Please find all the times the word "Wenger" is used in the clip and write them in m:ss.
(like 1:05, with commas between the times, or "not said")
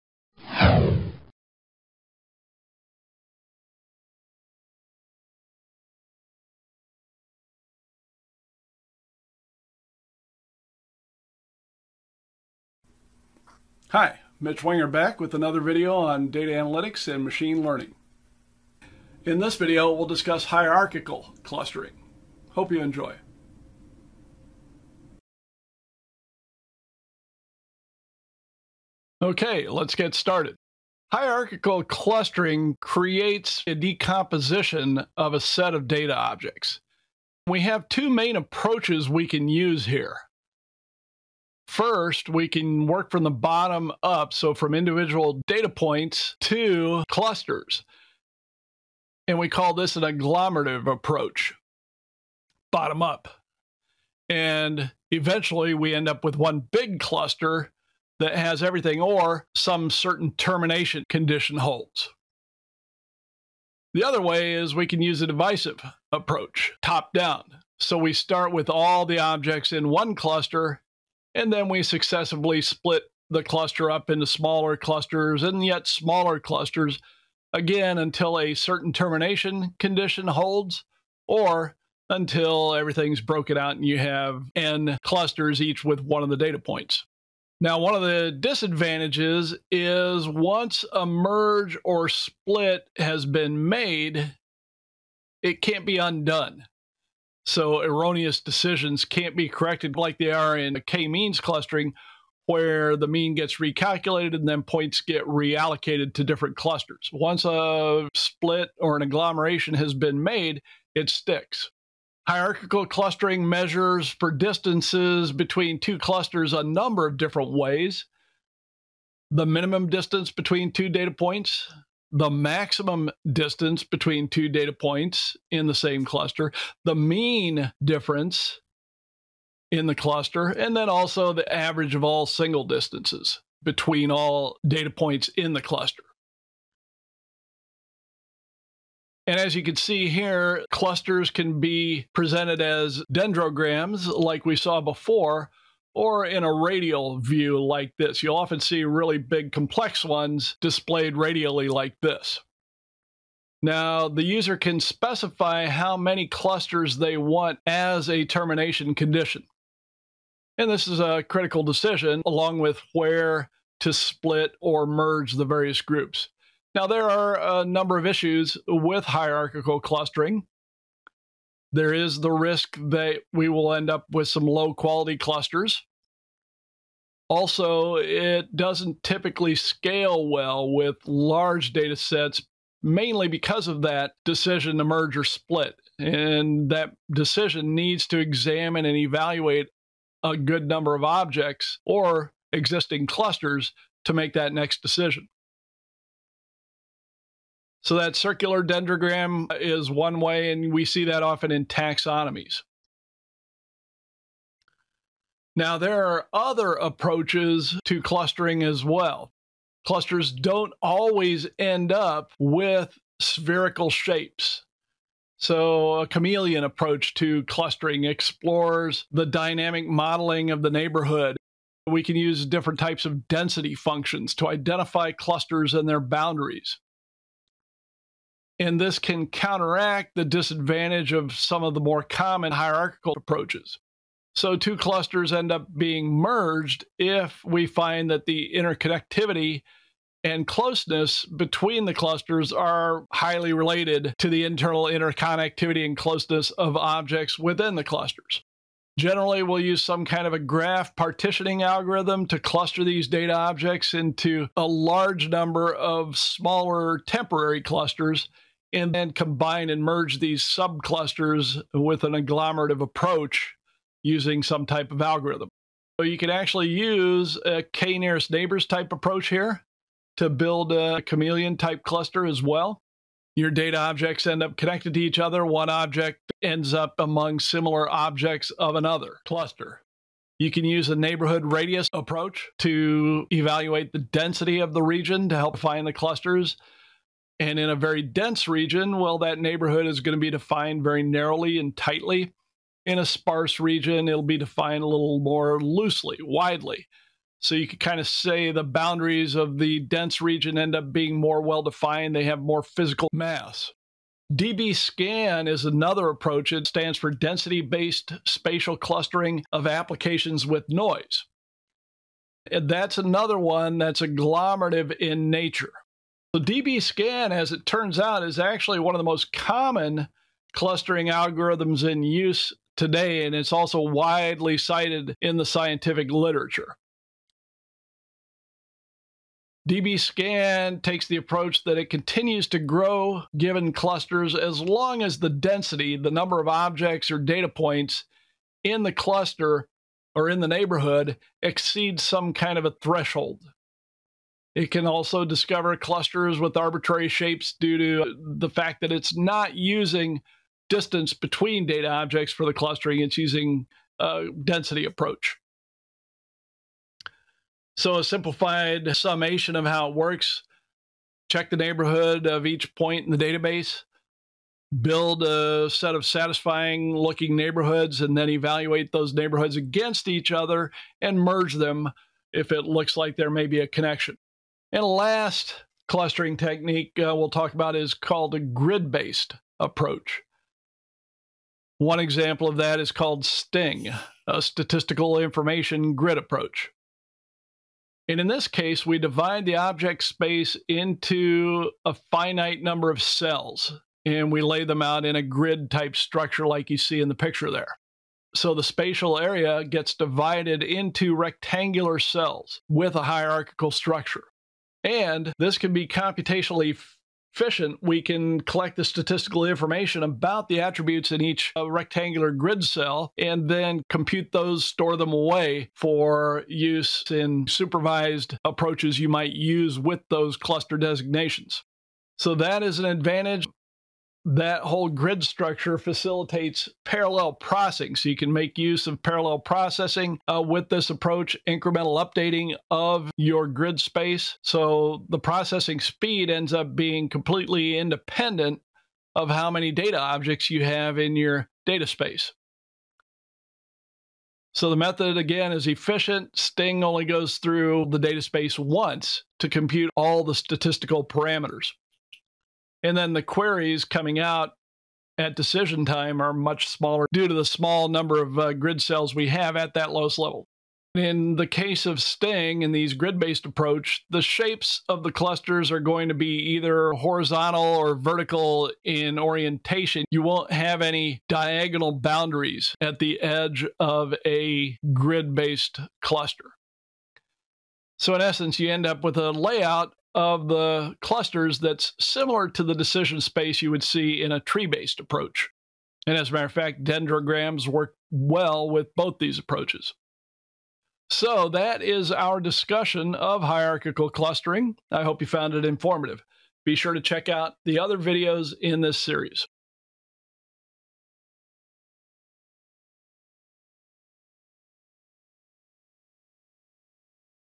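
0:14.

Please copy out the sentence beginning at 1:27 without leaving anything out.
Now, one of the disadvantages is once a merge or split has been made, it can't be undone.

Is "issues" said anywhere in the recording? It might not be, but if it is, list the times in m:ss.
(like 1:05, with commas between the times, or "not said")
2:48.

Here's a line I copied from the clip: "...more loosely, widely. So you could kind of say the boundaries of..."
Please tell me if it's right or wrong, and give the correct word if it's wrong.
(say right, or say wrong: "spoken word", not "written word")
right.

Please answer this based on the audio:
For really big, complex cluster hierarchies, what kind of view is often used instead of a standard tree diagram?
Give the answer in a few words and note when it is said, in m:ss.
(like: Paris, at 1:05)
radial view, at 2:26.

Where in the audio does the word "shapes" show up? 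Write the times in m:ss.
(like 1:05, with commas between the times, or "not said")
3:33, 5:47, 7:44.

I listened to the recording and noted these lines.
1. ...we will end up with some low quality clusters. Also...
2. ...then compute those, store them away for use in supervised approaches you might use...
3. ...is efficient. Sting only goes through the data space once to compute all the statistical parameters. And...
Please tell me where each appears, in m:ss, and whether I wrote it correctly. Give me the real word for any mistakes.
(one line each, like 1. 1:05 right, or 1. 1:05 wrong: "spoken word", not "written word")
1. 2:53 right
2. 6:53 right
3. 7:25 right.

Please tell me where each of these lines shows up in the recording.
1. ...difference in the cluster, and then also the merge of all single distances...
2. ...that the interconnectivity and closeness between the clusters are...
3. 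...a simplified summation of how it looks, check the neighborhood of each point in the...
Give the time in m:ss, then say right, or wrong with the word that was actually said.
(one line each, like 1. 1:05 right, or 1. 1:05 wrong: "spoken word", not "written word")
1. 2:07 wrong: "average", not "merge"
2. 3:58 right
3. 5:57 wrong: "works", not "looks".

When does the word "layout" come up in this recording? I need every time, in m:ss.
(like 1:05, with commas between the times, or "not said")
7:59.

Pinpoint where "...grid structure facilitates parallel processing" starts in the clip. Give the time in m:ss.
7:04.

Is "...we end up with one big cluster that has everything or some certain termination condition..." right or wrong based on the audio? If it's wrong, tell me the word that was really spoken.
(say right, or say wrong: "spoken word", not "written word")
right.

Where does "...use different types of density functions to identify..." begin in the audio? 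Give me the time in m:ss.
3:42.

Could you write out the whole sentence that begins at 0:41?
First, we can work from the bottom up, so from individual data points to clusters.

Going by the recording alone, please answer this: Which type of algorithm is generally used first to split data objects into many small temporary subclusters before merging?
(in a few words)
graph partitioning algorithm.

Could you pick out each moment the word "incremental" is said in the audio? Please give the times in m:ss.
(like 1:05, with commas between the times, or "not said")
7:11.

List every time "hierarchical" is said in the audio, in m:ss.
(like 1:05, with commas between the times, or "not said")
0:20, 0:31, 1:52, 2:49, 3:52, 6:43, 8:13.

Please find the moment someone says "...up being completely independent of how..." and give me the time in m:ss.
7:16.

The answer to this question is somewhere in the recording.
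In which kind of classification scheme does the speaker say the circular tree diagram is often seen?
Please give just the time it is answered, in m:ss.
3:21.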